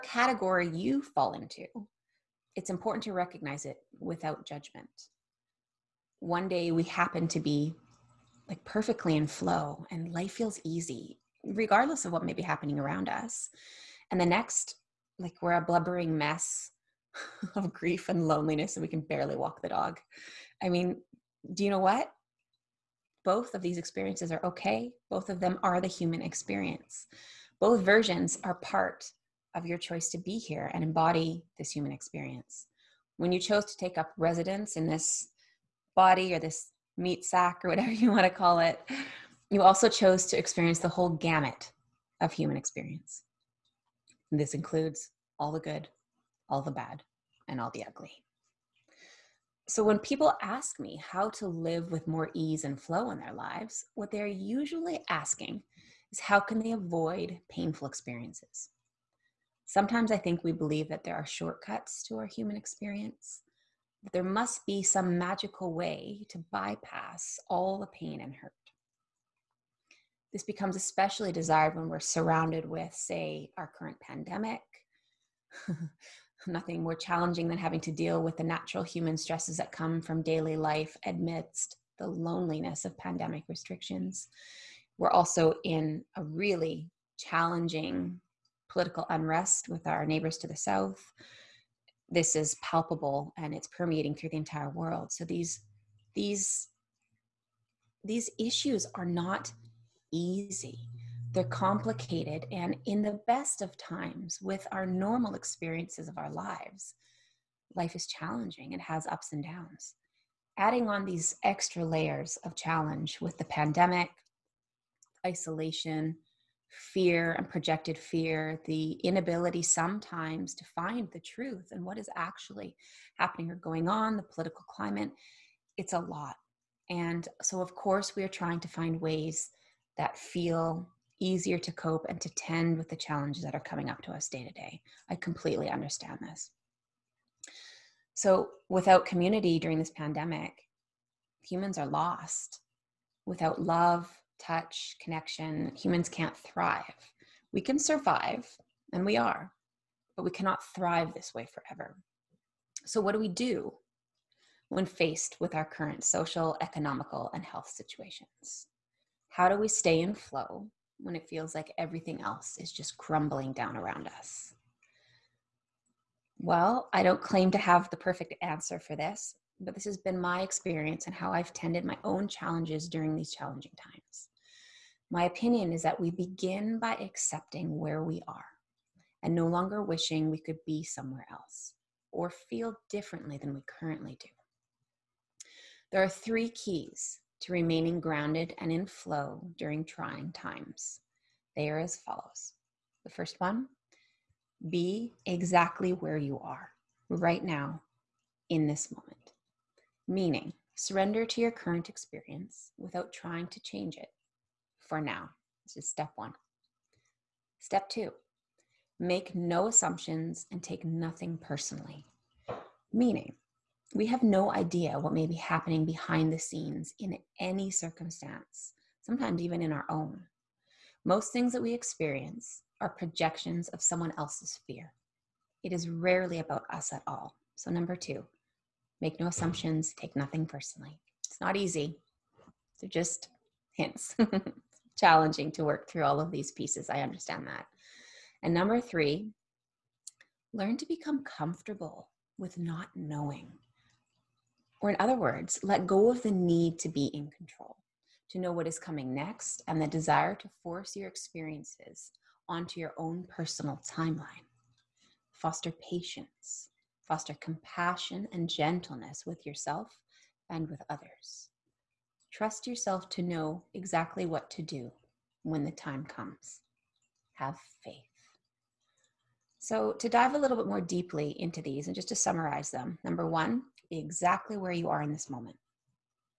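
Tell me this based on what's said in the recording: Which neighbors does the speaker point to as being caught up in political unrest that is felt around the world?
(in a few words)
neighbors to the south.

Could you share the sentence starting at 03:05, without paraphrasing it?
There are three keys to remaining grounded and in flow during trying times.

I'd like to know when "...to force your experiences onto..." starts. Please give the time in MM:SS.
04:10.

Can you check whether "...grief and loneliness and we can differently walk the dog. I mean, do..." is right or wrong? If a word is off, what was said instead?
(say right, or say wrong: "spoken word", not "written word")
wrong: "barely", not "differently".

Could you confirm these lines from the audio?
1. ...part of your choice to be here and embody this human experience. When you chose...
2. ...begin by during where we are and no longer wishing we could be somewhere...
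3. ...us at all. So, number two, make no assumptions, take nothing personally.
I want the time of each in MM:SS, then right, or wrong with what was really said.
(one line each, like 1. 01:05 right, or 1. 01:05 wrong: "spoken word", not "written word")
1. 00:28 right
2. 02:56 wrong: "accepting", not "during"
3. 03:46 right.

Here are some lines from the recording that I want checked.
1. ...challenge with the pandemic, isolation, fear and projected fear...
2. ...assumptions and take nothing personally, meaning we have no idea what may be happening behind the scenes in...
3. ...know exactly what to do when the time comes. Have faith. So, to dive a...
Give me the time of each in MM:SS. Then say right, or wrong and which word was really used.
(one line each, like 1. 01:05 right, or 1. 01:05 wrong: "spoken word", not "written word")
1. 01:52 right
2. 03:29 right
3. 04:23 right.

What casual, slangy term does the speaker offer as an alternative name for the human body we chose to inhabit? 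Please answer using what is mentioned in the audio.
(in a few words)
meat sack.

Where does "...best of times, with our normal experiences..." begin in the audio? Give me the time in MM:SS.
01:43.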